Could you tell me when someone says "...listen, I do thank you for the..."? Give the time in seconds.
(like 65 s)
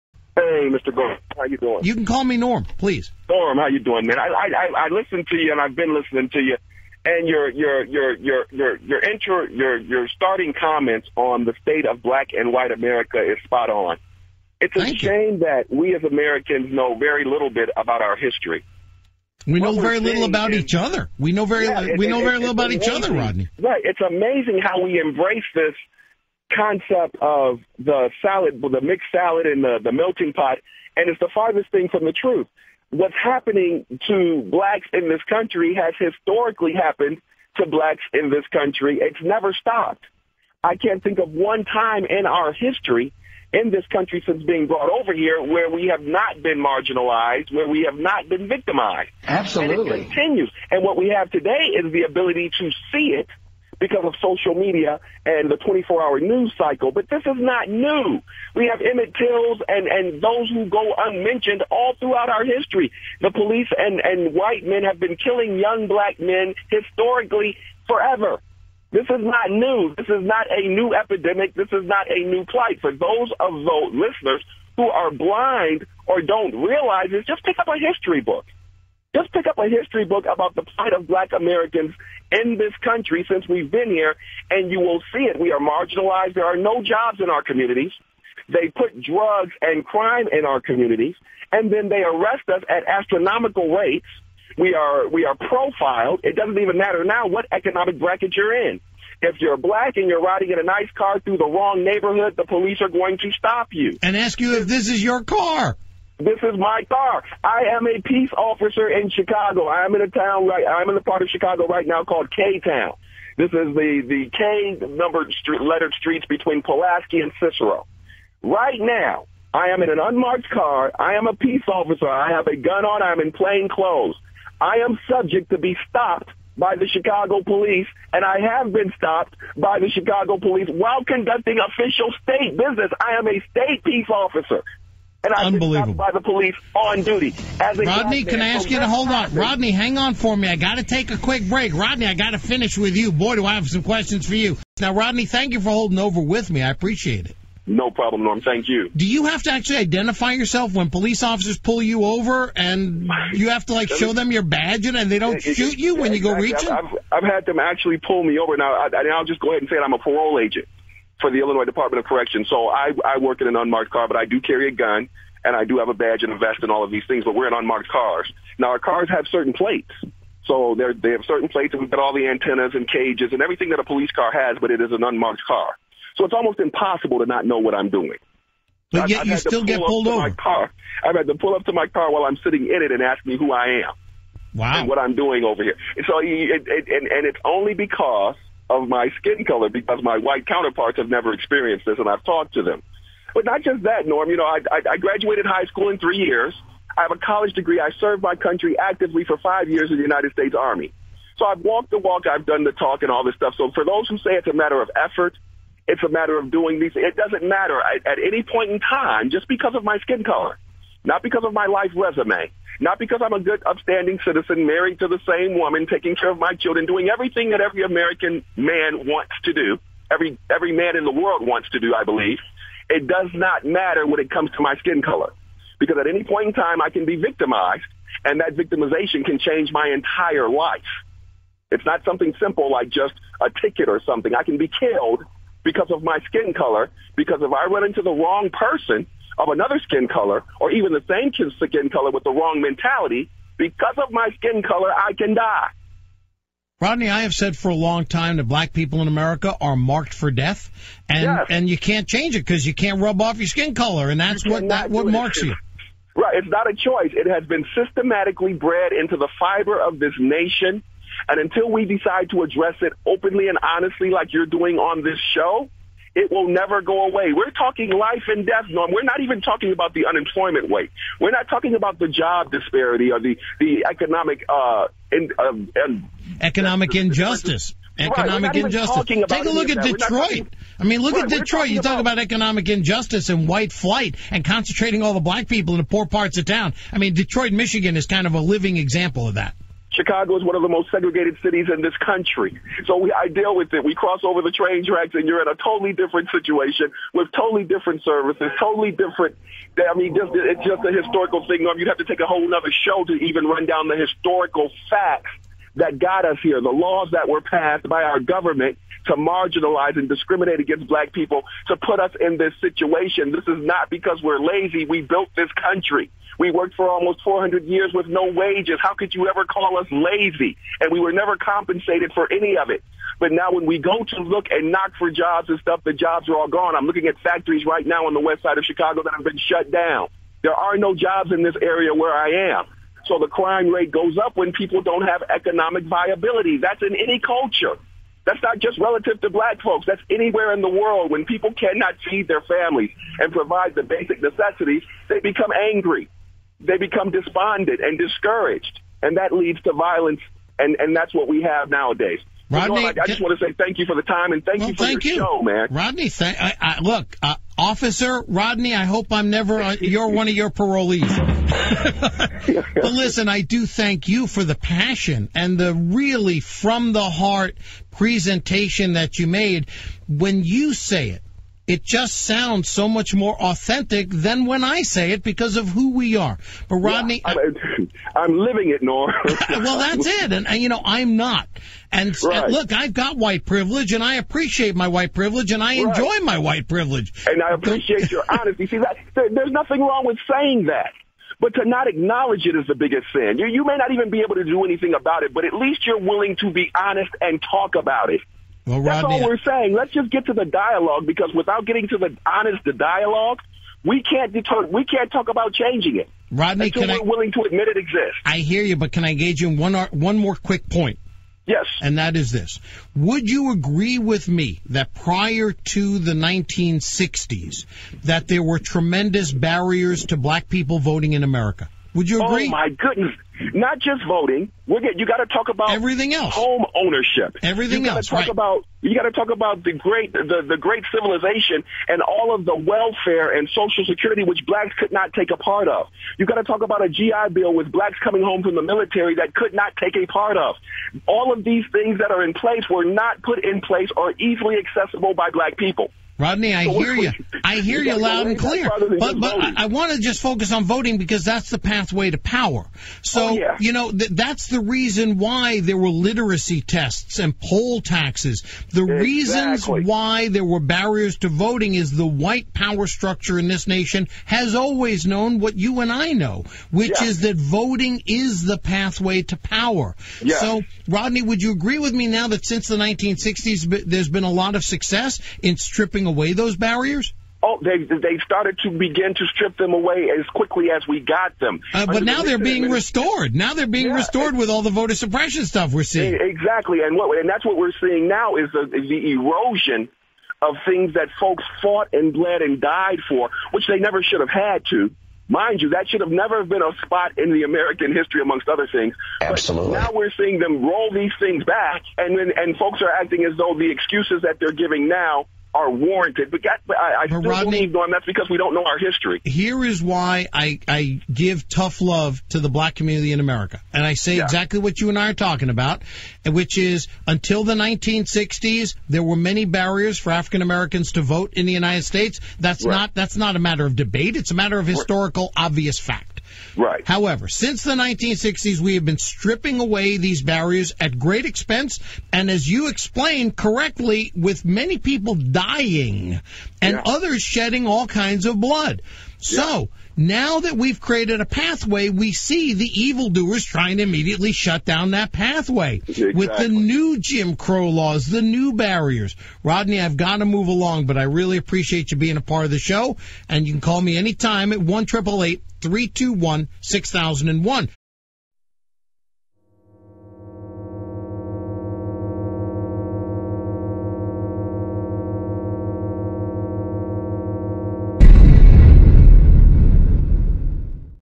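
362 s.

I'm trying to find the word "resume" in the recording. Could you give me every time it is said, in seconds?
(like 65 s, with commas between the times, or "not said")
211 s.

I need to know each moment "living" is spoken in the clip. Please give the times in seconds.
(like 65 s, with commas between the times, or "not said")
288 s, 378 s.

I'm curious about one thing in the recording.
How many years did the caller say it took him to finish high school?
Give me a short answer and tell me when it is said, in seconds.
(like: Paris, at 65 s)
3, at 195 s.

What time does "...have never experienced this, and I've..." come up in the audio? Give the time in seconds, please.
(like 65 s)
190 s.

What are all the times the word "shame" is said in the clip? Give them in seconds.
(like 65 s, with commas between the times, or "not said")
14 s.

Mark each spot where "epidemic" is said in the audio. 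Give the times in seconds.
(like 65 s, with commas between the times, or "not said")
70 s.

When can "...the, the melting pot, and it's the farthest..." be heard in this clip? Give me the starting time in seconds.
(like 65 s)
29 s.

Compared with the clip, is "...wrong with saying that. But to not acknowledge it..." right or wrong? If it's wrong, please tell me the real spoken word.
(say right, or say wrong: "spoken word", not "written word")
right.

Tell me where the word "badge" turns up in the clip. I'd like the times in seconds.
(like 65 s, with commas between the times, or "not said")
154 s, 165 s.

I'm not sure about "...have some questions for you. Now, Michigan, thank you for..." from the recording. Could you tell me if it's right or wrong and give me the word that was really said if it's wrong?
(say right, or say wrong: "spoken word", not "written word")
wrong: "Rodney", not "Michigan".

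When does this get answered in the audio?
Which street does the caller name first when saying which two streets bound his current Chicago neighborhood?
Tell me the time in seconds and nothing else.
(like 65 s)
116 s.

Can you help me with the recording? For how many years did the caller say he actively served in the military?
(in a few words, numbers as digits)
5.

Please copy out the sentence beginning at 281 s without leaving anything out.
You talk about, about economic injustice and white flight and concentrating all the black people in the poor parts of town.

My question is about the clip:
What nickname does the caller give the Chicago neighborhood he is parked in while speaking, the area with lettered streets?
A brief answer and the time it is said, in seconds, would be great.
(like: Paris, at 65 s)
K Town, at 112 s.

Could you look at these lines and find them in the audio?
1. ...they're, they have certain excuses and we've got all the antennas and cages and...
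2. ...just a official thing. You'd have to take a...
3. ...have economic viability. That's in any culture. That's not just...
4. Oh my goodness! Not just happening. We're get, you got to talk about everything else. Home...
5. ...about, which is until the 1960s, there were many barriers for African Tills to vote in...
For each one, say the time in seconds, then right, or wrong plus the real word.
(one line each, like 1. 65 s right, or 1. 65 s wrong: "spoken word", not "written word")
1. 170 s wrong: "plates", not "excuses"
2. 300 s wrong: "historical", not "official"
3. 335 s right
4. 422 s wrong: "voting", not "happening"
5. 515 s wrong: "Americans", not "Tills".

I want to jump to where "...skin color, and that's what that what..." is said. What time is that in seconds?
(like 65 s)
253 s.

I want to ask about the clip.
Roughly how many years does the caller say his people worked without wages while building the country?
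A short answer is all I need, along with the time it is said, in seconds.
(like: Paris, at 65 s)
400, at 317 s.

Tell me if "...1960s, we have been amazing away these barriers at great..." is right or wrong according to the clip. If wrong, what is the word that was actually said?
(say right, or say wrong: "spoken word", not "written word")
wrong: "stripping", not "amazing".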